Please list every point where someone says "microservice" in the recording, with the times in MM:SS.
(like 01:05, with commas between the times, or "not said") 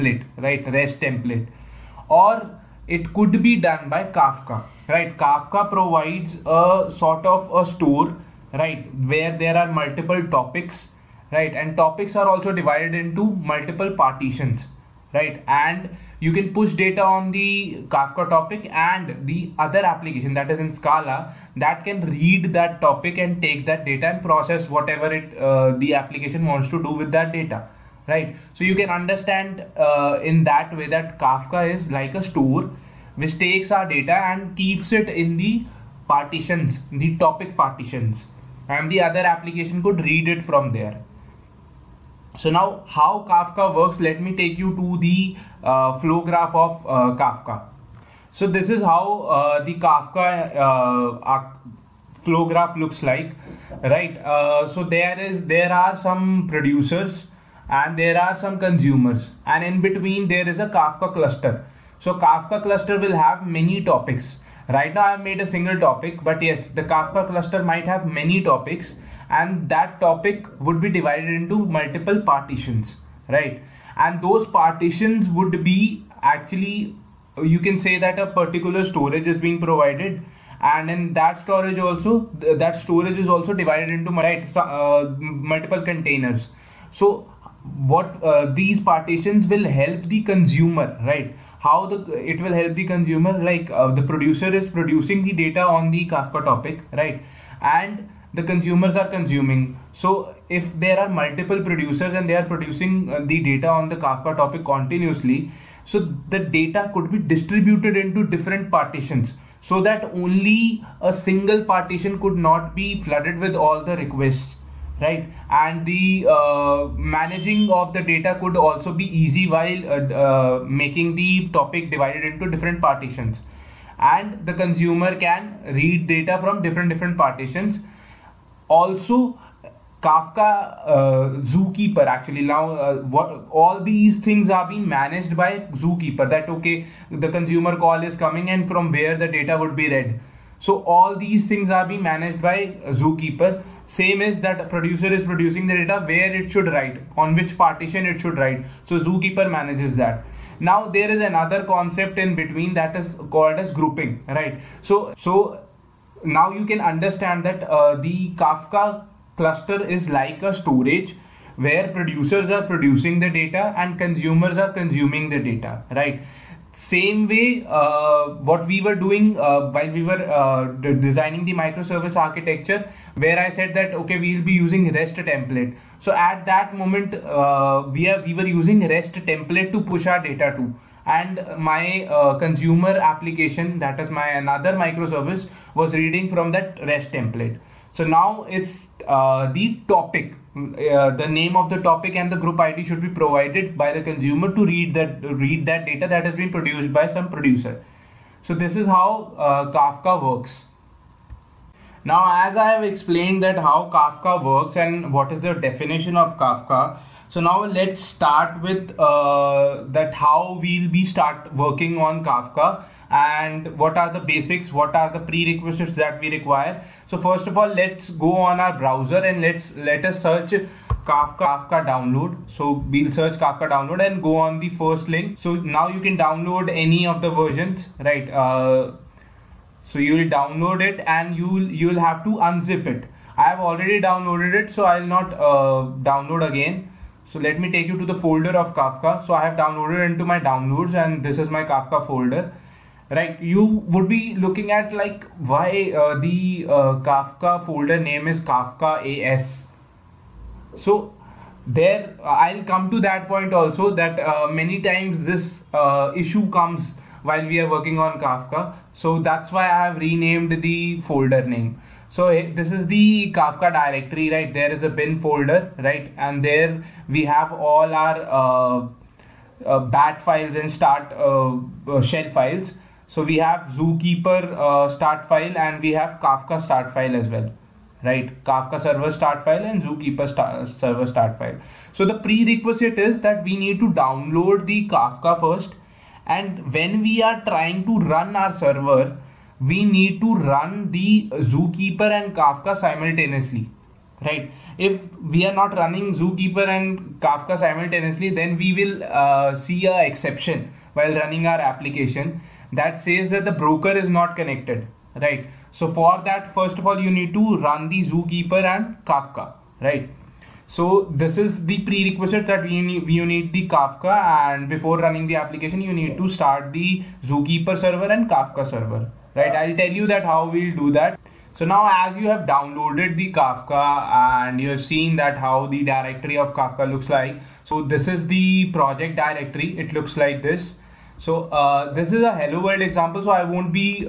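02:51, 03:04.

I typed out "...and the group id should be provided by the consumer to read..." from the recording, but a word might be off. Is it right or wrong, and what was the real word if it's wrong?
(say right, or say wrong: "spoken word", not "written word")
right.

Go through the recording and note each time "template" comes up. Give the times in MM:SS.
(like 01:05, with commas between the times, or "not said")
00:01, 02:55, 02:59, 03:07.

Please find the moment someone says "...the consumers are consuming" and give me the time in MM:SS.
01:38.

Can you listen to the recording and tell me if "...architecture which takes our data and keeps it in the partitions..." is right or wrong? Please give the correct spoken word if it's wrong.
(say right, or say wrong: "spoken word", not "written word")
wrong: "store", not "architecture".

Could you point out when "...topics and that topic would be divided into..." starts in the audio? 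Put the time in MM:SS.
01:08.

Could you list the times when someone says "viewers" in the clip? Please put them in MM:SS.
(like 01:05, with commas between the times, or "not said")
not said.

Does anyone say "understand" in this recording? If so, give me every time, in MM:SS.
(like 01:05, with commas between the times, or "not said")
00:28, 02:36.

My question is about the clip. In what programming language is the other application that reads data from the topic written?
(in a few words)
Scala.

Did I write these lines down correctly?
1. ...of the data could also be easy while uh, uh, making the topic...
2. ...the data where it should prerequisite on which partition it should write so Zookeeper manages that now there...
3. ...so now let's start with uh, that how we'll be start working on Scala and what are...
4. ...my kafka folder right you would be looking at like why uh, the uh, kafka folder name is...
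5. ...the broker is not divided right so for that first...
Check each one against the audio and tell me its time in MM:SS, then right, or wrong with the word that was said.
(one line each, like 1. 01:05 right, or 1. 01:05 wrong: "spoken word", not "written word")
1. 01:57 right
2. 02:25 wrong: "write", not "prerequisite"
3. 03:27 wrong: "Kafka", not "Scala"
4. 04:01 right
5. 05:03 wrong: "connected", not "divided".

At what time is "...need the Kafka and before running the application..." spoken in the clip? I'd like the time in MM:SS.
05:13.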